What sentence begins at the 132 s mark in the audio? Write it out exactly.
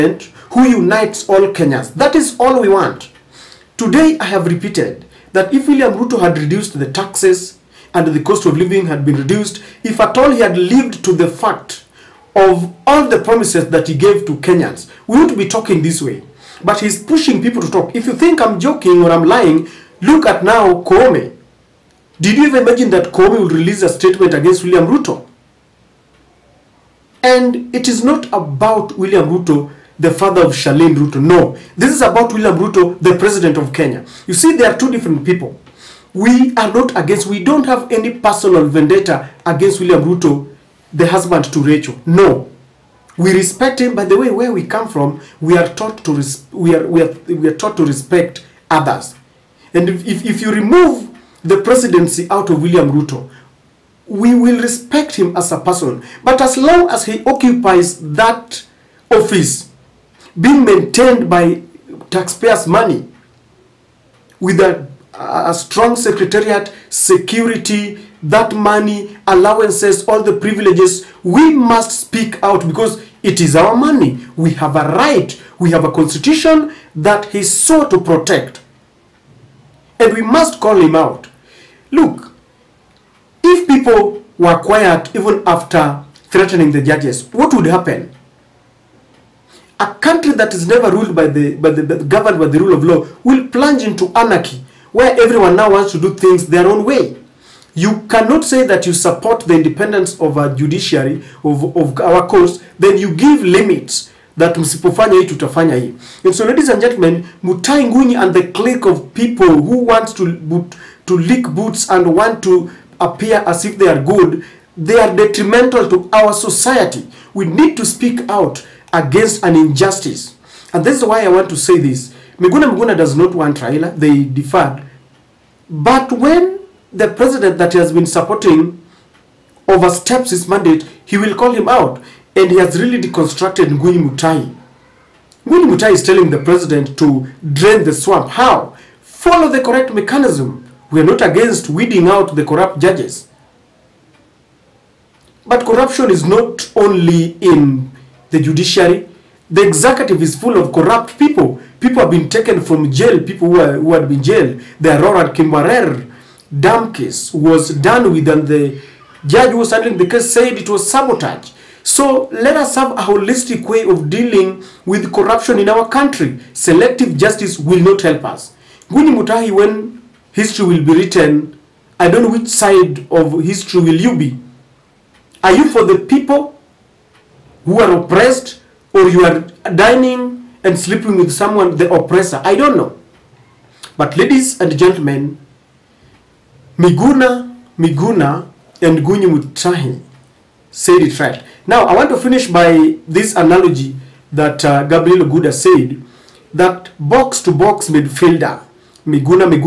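And he has really deconstructed Ngunyi Mutai.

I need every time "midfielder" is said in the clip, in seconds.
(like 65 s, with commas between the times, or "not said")
197 s.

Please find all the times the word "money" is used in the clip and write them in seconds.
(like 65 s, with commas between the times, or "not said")
62 s, 68 s, 73 s.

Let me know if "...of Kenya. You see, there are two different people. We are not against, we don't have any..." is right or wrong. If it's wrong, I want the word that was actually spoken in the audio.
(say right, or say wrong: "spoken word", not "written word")
right.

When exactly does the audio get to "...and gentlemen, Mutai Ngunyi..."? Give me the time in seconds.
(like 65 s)
106 s.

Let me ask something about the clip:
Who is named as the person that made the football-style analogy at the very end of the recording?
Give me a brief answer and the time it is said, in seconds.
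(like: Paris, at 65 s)
Gabriel Oguda, at 194 s.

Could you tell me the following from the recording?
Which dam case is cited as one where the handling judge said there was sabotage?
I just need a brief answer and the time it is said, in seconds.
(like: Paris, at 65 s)
Arror Kimwarer, at 154 s.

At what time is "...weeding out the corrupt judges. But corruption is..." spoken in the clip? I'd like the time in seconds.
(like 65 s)
141 s.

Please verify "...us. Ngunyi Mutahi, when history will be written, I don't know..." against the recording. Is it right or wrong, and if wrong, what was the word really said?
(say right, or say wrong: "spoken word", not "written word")
right.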